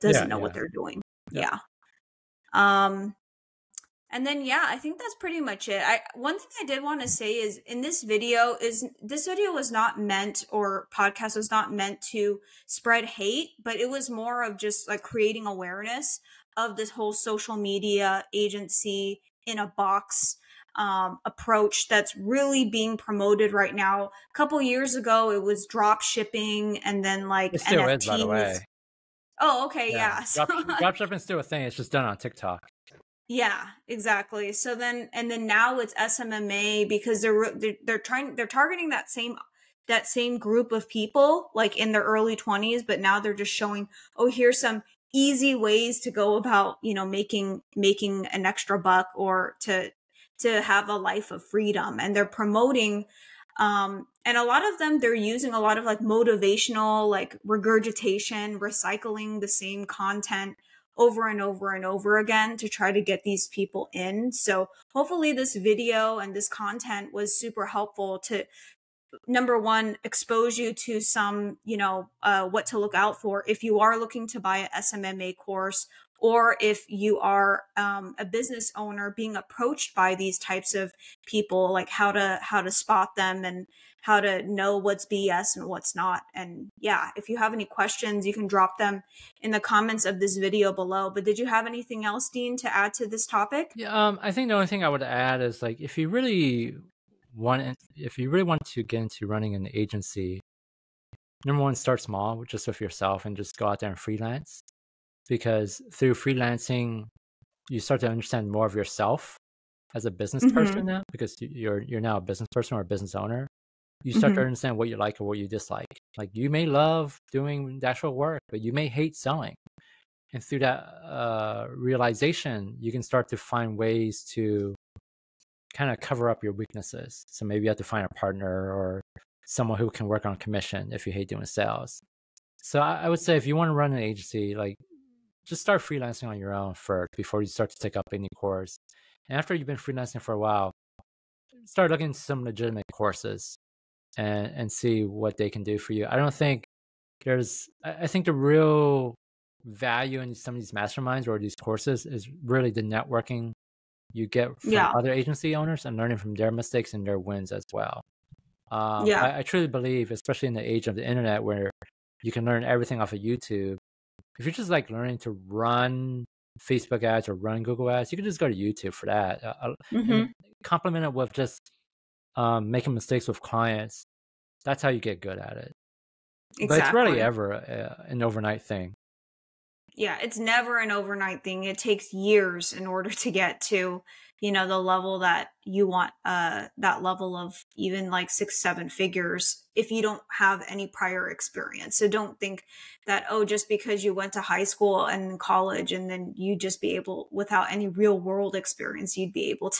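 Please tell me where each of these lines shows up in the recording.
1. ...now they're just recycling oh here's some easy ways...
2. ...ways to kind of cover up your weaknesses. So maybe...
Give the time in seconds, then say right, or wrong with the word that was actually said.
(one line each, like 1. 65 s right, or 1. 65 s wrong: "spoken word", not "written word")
1. 42 s wrong: "showing", not "recycling"
2. 123 s right.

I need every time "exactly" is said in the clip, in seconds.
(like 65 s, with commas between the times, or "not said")
33 s, 176 s.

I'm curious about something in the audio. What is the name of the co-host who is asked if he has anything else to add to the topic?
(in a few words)
Dean.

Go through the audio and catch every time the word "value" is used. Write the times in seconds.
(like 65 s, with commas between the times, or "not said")
149 s.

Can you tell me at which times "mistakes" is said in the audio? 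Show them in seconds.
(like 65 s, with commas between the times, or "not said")
156 s, 172 s.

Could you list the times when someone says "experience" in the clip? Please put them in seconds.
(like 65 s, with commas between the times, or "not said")
191 s, 198 s.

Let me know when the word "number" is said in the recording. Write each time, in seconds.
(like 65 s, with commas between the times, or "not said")
69 s, 101 s.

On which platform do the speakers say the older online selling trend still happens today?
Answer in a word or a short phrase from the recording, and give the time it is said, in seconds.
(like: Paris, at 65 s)
TikTok, at 32 s.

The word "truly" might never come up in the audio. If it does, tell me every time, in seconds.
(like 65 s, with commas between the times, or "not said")
159 s.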